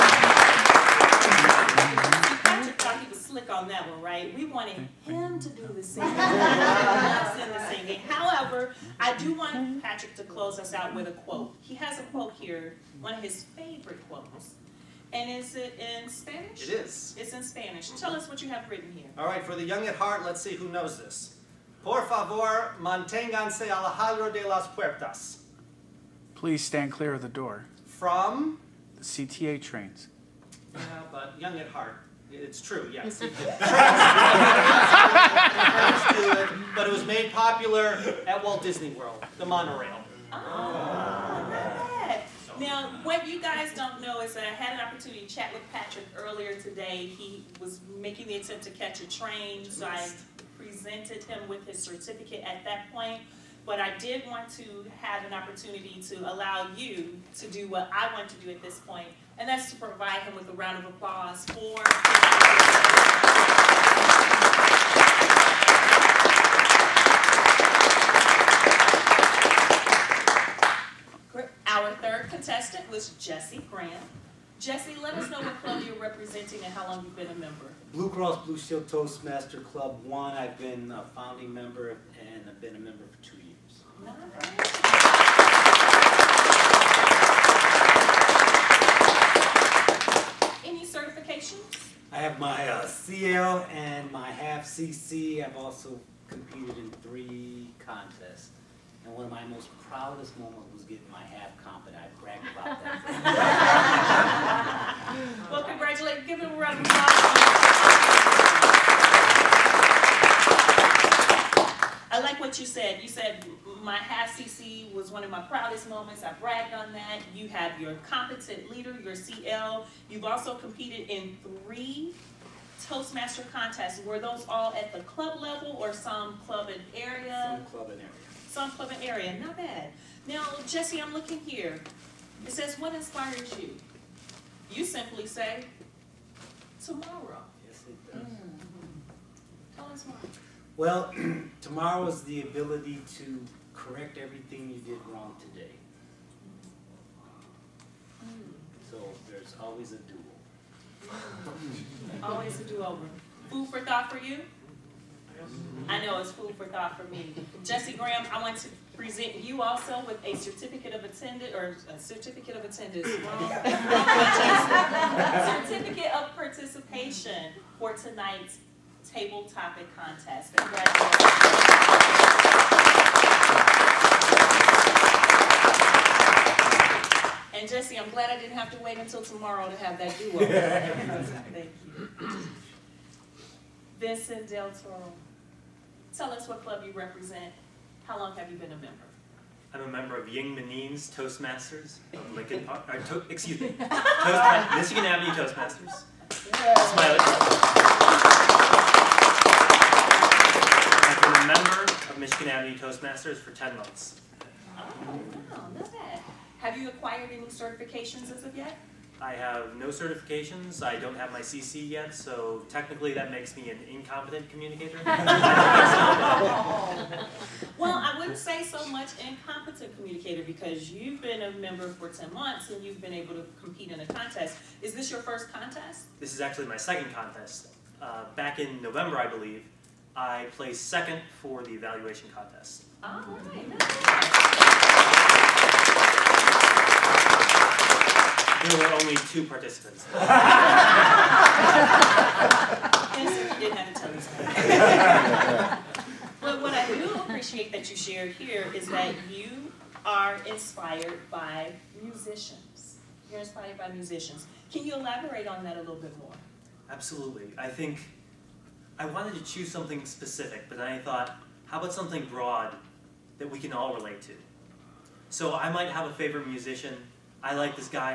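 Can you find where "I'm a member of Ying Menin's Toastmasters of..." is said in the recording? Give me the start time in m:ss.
3:09.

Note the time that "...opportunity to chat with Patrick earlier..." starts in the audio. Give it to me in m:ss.
0:44.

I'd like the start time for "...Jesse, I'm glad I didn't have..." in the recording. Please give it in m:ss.
2:57.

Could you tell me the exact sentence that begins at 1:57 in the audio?
You have your competent leader, your CL.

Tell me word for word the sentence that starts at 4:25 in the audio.
So I might have a favorite musician.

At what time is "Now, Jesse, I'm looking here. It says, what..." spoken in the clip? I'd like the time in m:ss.
2:10.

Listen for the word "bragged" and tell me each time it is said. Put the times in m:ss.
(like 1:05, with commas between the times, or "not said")
1:42, 1:56.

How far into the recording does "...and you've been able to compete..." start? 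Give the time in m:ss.
3:42.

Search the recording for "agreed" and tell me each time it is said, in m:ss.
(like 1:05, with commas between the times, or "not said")
not said.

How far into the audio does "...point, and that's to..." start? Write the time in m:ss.
0:58.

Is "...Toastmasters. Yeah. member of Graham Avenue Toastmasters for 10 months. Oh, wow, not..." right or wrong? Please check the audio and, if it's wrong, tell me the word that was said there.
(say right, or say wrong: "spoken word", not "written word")
wrong: "Michigan", not "Graham".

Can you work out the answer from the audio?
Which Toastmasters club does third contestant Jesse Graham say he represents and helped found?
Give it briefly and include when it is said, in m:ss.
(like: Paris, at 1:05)
Blue Cross Blue Shield Toastmaster Club 1, at 1:17.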